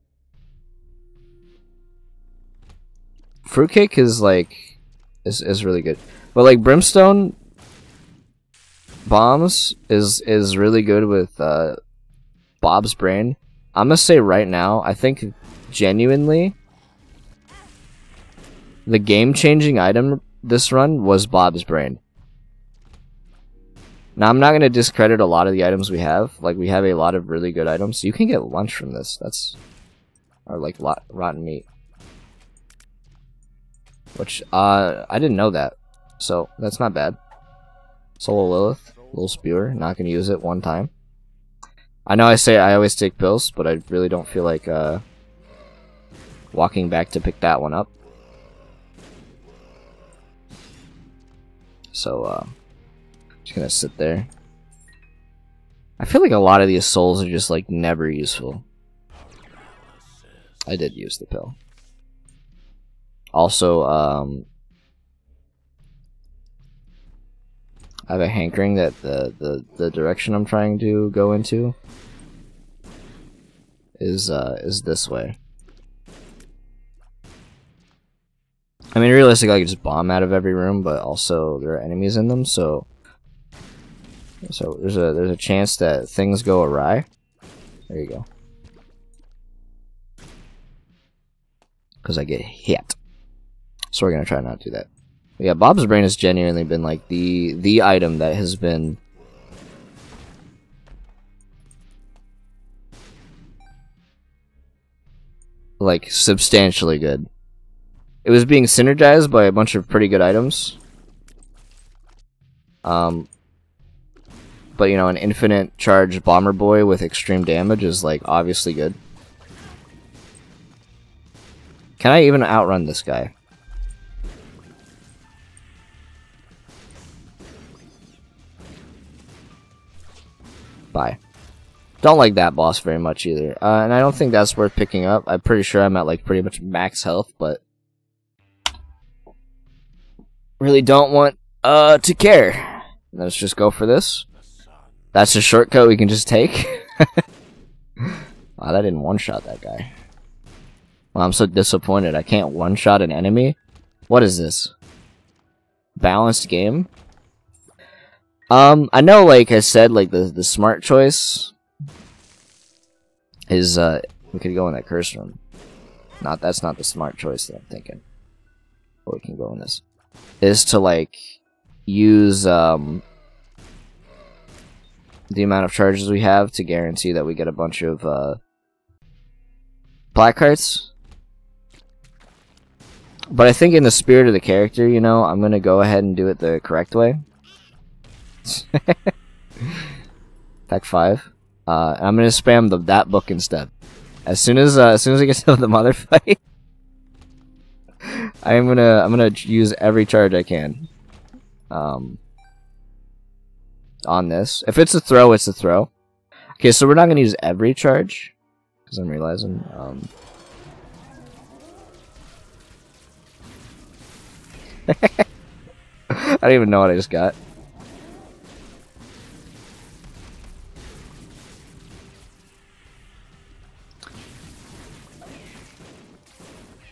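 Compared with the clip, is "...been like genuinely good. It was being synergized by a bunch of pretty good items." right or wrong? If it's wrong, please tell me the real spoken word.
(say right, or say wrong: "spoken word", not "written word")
wrong: "substantially", not "genuinely".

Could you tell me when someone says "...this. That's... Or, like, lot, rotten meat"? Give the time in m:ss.
0:28.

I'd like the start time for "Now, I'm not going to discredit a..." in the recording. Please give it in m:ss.
0:24.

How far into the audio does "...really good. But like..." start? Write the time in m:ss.
0:05.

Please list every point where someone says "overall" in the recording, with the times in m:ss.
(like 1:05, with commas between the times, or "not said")
not said.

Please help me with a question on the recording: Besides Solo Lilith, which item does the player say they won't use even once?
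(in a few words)
Little Spewer.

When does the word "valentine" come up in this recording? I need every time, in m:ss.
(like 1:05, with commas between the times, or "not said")
not said.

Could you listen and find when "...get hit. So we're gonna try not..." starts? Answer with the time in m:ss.
1:32.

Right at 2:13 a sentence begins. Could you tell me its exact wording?
Uh, and I don't think that's worth picking up.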